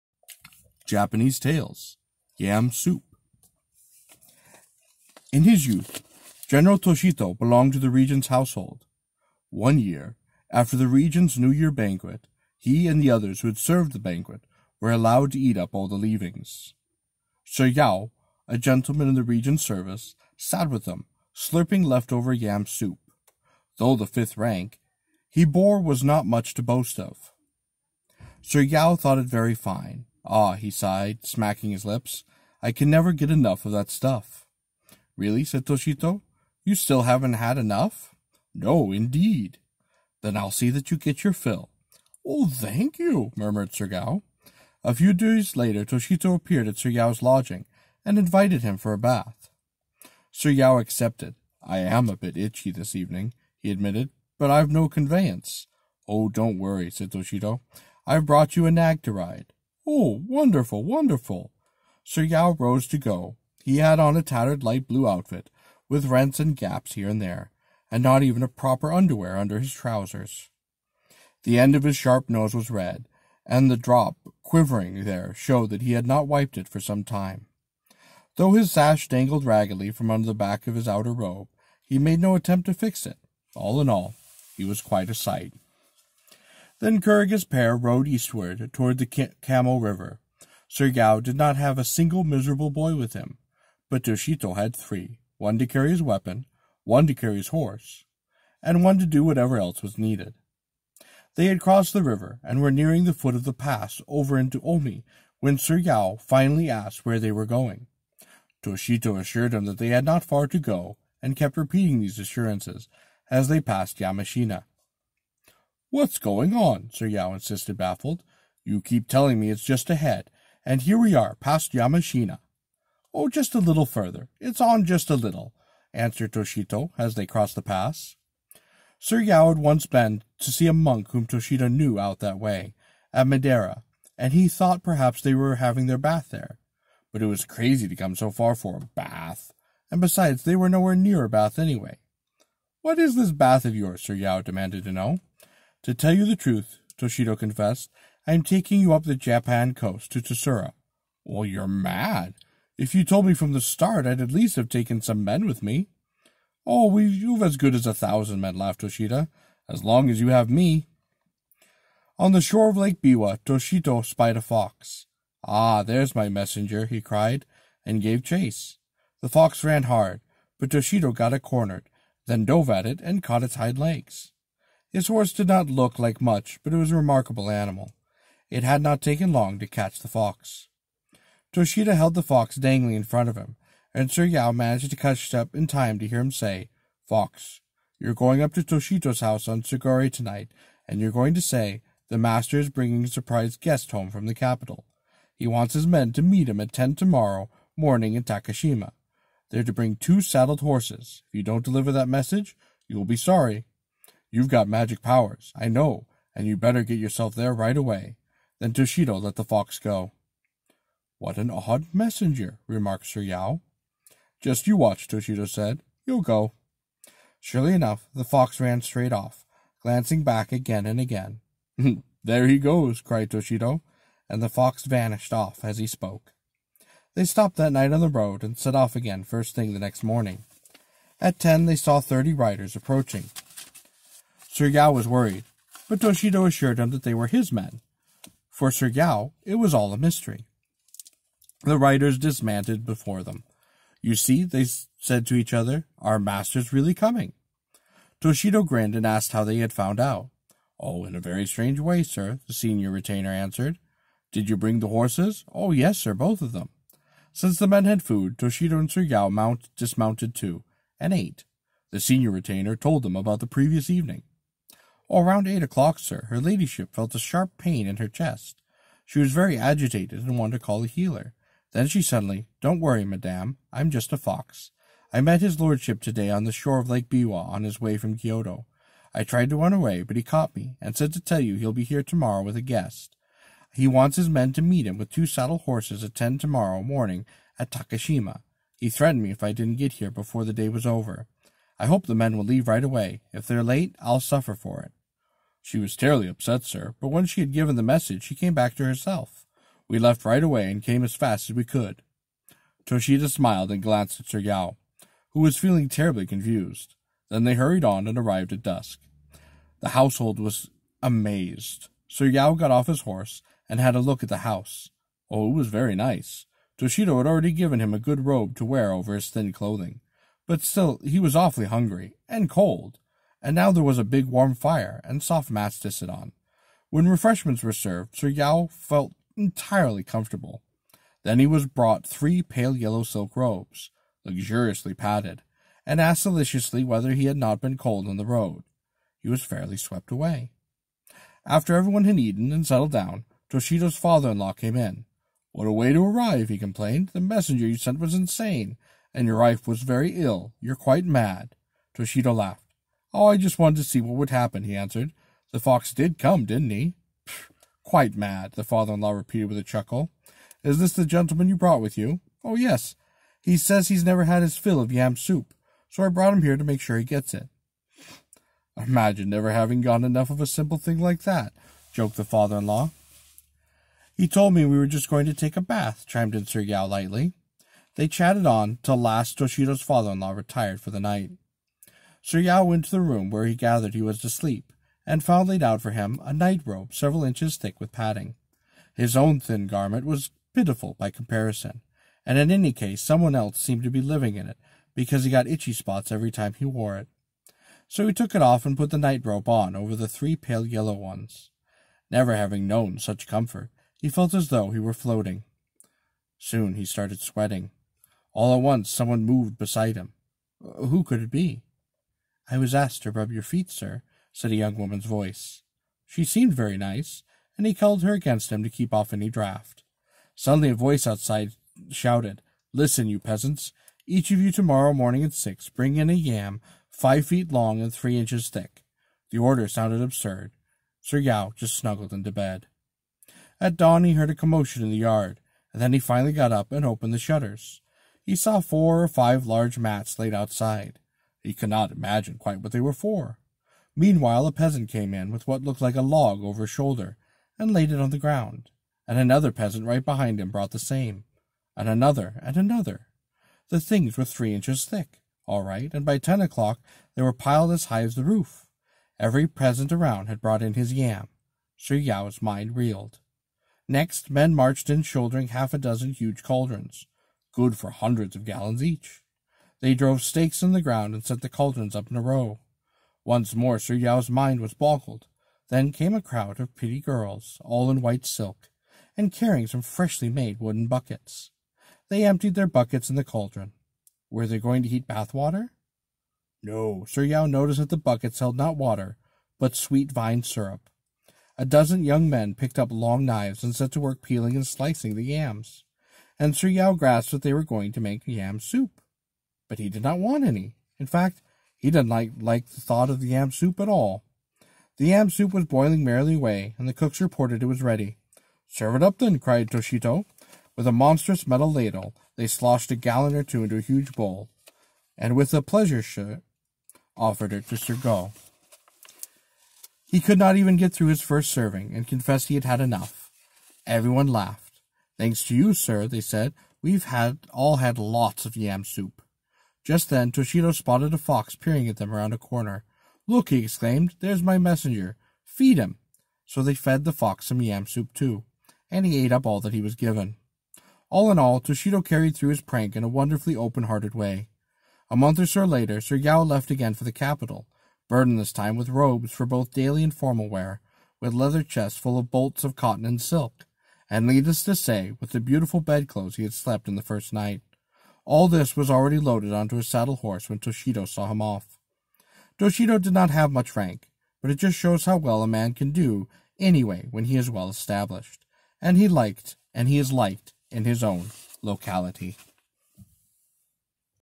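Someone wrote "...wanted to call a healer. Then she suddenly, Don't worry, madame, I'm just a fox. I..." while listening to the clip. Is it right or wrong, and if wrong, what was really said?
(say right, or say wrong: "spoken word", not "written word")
right.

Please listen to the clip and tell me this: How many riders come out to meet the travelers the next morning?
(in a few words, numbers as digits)
30.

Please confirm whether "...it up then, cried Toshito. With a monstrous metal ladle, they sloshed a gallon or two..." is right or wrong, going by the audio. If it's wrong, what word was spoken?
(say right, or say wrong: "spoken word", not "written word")
right.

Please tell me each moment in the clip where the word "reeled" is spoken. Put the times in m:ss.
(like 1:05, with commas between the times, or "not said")
7:42.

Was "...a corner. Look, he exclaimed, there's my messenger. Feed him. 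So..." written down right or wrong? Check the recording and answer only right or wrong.
right.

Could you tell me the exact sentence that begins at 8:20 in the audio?
In fact, he did not like, like the thought of the yam soup at all.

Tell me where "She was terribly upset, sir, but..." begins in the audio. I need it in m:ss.
4:55.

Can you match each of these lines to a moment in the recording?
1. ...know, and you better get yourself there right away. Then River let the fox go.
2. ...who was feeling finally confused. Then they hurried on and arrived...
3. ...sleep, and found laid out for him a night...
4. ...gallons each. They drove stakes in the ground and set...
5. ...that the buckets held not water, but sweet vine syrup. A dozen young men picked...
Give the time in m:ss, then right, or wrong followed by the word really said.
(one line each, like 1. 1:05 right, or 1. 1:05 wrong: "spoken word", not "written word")
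1. 3:25 wrong: "Toshito", not "River"
2. 5:05 wrong: "terribly", not "finally"
3. 6:24 right
4. 7:48 right
5. 8:07 right.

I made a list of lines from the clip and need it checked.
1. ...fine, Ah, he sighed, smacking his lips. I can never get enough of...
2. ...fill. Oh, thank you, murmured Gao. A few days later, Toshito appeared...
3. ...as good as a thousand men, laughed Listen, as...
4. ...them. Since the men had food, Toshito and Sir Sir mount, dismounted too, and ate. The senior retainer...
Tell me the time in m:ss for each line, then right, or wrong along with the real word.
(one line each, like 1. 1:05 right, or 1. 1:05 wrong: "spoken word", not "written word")
1. 0:29 right
2. 0:41 wrong: "Sergao", not "Gao"
3. 2:37 wrong: "Toshito", not "Listen"
4. 4:16 wrong: "Yao", not "Sir".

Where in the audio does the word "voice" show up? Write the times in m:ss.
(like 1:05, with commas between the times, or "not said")
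6:55, 7:00.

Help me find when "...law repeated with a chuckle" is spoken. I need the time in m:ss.
5:59.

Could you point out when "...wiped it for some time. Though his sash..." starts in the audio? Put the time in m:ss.
1:16.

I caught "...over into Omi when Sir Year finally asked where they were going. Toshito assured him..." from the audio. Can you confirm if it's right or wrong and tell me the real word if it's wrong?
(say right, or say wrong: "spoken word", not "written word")
wrong: "Yao", not "Year".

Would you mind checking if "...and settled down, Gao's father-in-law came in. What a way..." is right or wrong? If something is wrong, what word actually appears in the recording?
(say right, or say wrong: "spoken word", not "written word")
wrong: "Toshito", not "Gao".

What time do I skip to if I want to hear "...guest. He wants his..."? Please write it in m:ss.
4:42.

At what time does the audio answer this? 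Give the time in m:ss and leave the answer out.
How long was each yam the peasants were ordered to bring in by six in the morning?
7:06.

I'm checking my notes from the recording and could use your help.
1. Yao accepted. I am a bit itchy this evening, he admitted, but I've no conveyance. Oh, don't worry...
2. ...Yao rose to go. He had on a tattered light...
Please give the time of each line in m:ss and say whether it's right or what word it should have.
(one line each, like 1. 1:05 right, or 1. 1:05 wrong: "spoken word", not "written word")
1. 0:50 right
2. 1:02 right.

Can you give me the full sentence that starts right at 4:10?
Oh, in a very strange way, sir, the senior retainer answered.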